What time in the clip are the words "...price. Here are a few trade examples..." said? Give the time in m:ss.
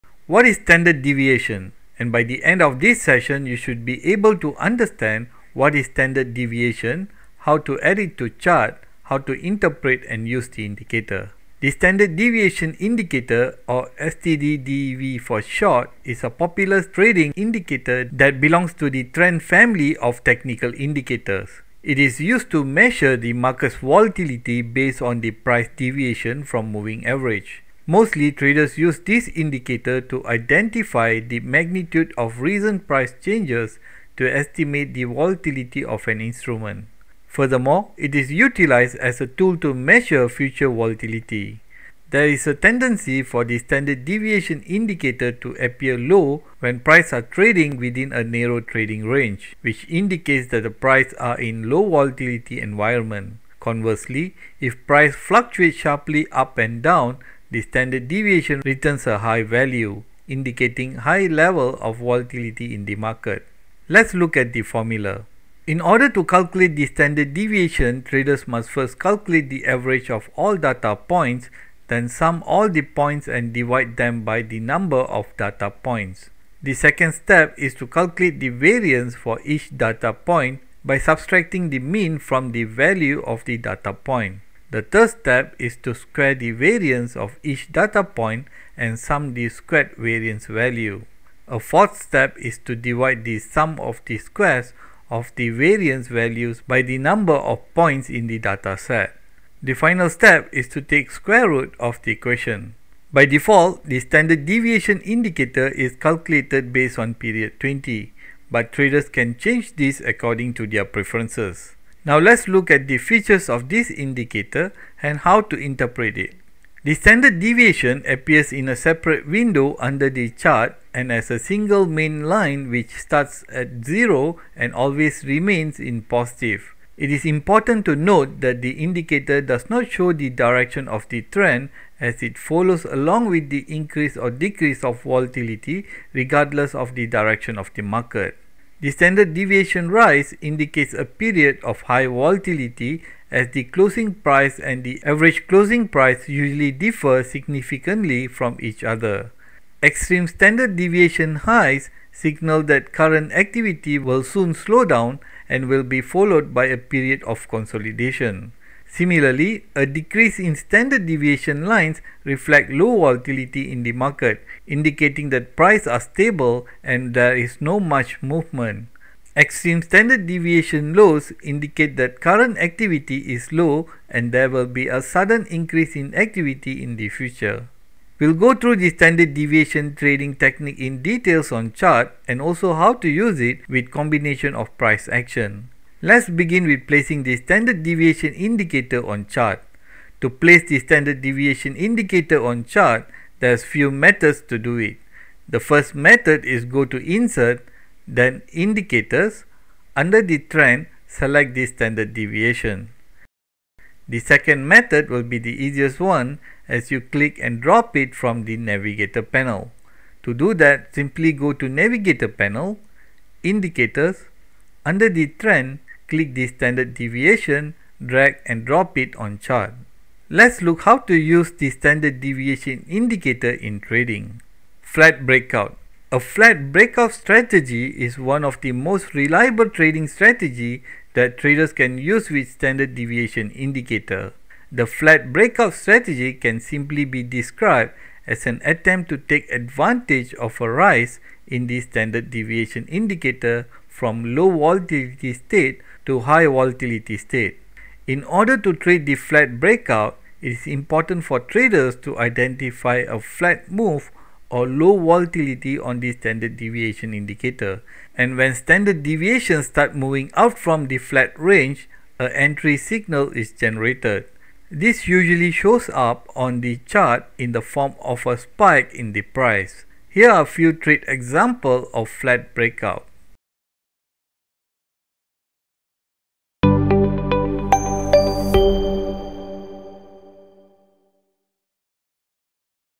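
4:29.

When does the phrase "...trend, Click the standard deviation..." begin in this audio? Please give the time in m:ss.
3:35.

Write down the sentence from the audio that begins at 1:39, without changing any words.
The final step is to take square root of the equation.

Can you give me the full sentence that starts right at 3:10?
To place the standard deviation indicator on chart, there's few methods to do it.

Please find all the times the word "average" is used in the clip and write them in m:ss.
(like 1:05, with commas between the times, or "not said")
0:27, 1:09, 2:25.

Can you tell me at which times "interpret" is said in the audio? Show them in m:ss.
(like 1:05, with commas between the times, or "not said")
0:09, 1:55.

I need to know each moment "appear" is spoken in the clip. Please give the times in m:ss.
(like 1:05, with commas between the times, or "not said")
0:45, 1:58.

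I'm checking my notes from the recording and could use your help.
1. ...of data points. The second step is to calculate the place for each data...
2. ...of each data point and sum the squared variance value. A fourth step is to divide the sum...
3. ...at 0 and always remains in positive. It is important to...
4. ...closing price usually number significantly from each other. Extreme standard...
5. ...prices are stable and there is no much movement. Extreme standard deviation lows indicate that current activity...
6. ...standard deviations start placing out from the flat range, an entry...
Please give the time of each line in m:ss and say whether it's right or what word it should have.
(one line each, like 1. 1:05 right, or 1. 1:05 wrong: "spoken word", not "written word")
1. 1:15 wrong: "variance", not "place"
2. 1:27 right
3. 2:03 right
4. 2:25 wrong: "differ", not "number"
5. 2:45 right
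6. 4:18 wrong: "moving", not "placing".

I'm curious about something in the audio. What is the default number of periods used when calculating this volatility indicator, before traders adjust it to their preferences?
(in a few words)
20.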